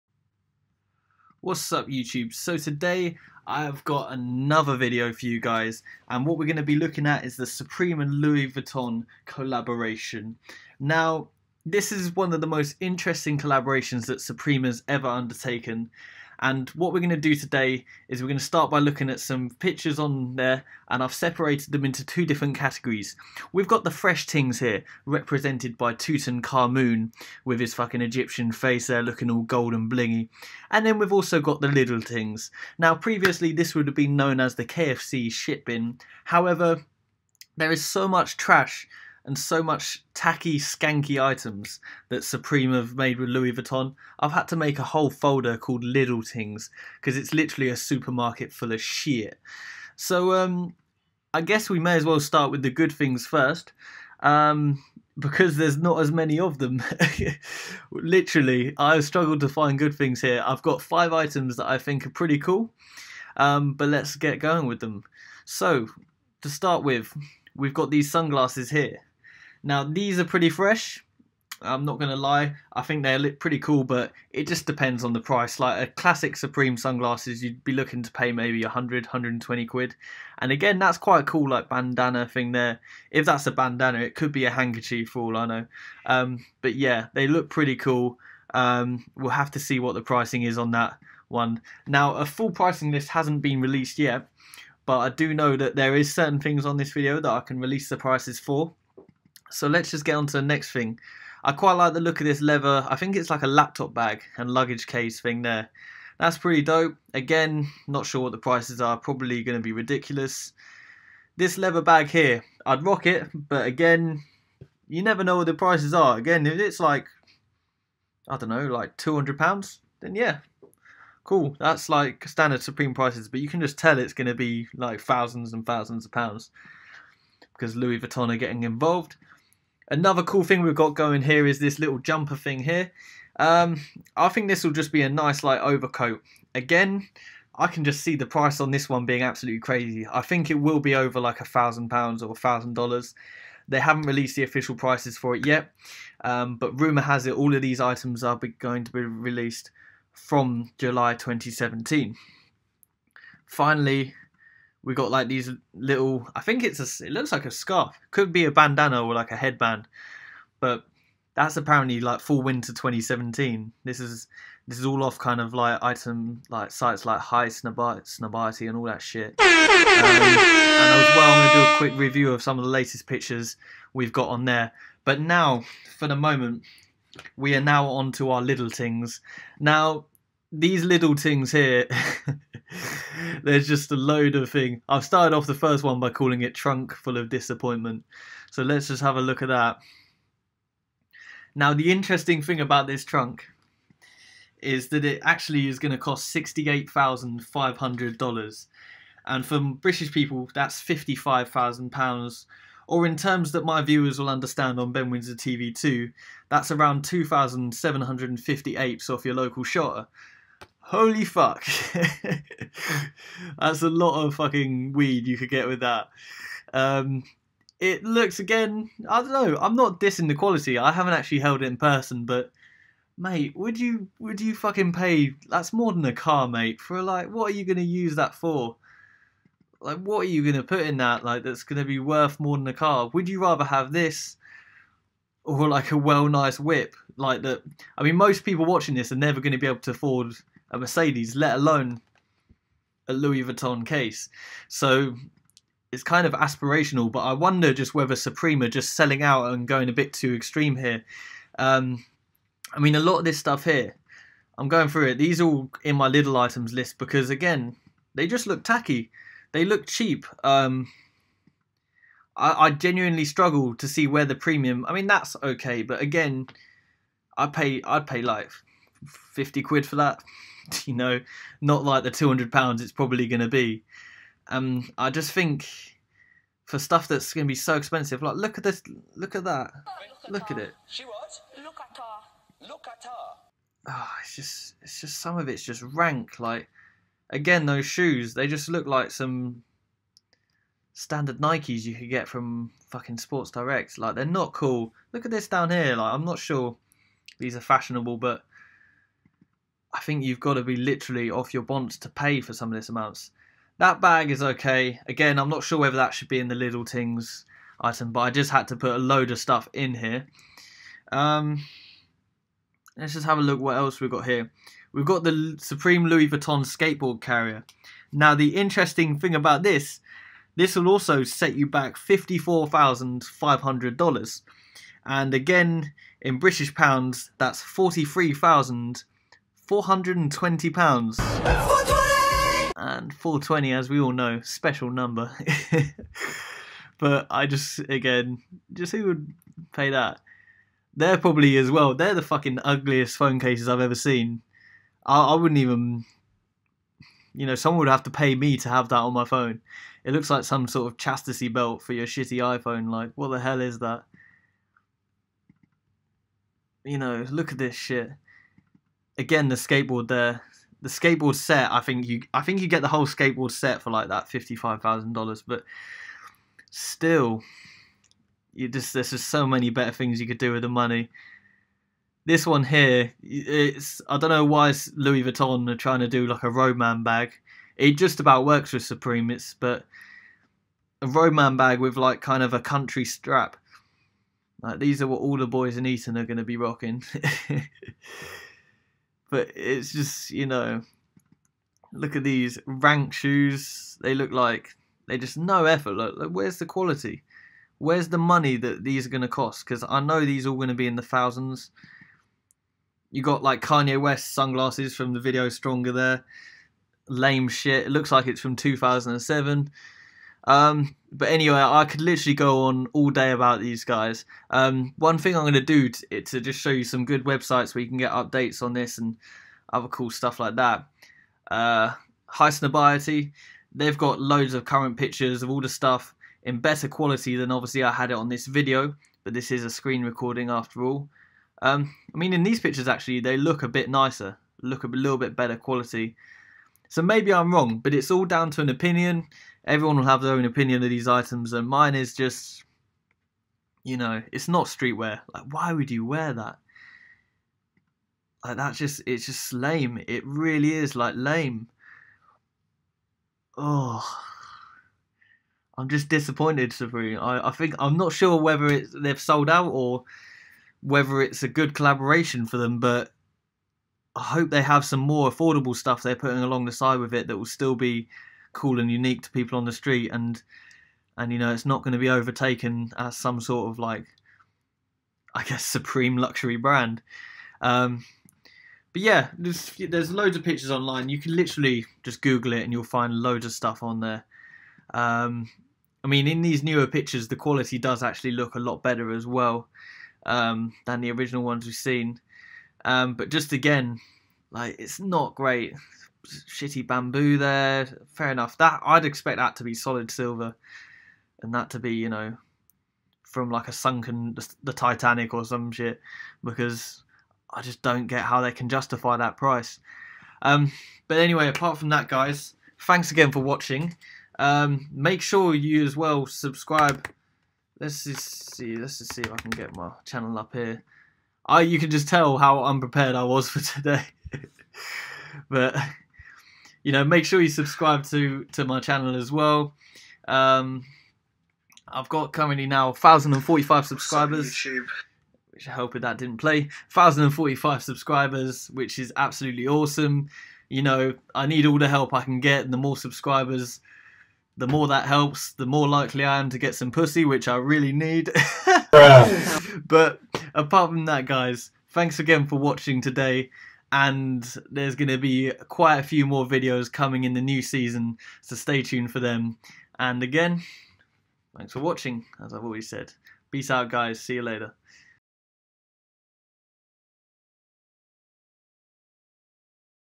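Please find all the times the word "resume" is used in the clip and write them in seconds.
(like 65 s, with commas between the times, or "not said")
not said.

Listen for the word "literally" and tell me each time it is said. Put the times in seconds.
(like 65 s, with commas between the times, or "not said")
47 s, 57 s, 300 s, 411 s, 481 s.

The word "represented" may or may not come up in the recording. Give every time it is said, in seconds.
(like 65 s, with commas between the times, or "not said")
25 s.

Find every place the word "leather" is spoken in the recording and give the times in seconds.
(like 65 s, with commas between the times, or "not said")
102 s, 111 s.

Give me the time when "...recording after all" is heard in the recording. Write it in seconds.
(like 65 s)
430 s.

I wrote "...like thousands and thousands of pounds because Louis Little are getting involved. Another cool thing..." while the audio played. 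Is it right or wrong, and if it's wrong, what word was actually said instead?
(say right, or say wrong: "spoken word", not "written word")
wrong: "Vuitton", not "Little".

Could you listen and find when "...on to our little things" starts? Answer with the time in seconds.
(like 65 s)
177 s.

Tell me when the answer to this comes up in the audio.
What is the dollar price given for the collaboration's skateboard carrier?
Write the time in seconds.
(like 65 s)
321 s.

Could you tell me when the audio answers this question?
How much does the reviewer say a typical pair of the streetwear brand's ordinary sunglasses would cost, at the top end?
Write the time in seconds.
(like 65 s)
79 s.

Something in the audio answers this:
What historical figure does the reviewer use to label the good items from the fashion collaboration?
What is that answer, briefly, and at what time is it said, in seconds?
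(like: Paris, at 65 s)
Tutankhamun, at 25 s.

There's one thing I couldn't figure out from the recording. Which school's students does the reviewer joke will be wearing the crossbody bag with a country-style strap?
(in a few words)
Eton.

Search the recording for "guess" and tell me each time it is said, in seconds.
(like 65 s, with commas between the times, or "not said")
51 s, 475 s.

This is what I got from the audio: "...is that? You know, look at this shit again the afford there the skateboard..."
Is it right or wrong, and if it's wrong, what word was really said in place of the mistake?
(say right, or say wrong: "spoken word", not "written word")
wrong: "skateboard", not "afford".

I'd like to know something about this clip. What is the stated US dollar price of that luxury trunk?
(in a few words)
$68,500.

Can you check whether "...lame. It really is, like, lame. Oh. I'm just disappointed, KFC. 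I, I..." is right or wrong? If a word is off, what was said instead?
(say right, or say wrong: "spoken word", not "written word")
wrong: "Supreme", not "KFC".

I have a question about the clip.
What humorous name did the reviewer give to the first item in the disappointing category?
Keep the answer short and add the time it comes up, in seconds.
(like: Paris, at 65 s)
Trunk Full of Disappointment, at 186 s.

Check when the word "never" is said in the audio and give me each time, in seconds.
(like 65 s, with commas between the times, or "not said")
115 s, 239 s.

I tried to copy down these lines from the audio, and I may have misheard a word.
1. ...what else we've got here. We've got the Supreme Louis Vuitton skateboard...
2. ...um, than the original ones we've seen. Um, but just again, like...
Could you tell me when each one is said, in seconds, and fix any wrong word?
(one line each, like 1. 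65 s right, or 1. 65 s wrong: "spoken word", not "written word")
1. 313 s right
2. 490 s right.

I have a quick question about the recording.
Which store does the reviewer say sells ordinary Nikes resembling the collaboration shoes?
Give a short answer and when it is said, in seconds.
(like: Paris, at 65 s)
Sports Direct, at 293 s.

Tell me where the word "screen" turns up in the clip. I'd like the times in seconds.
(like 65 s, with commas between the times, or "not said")
429 s.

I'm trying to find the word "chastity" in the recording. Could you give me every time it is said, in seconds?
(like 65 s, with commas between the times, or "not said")
350 s.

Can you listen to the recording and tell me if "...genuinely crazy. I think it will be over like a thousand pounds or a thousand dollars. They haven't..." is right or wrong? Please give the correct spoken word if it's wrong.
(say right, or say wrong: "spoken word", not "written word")
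wrong: "absolutely", not "genuinely".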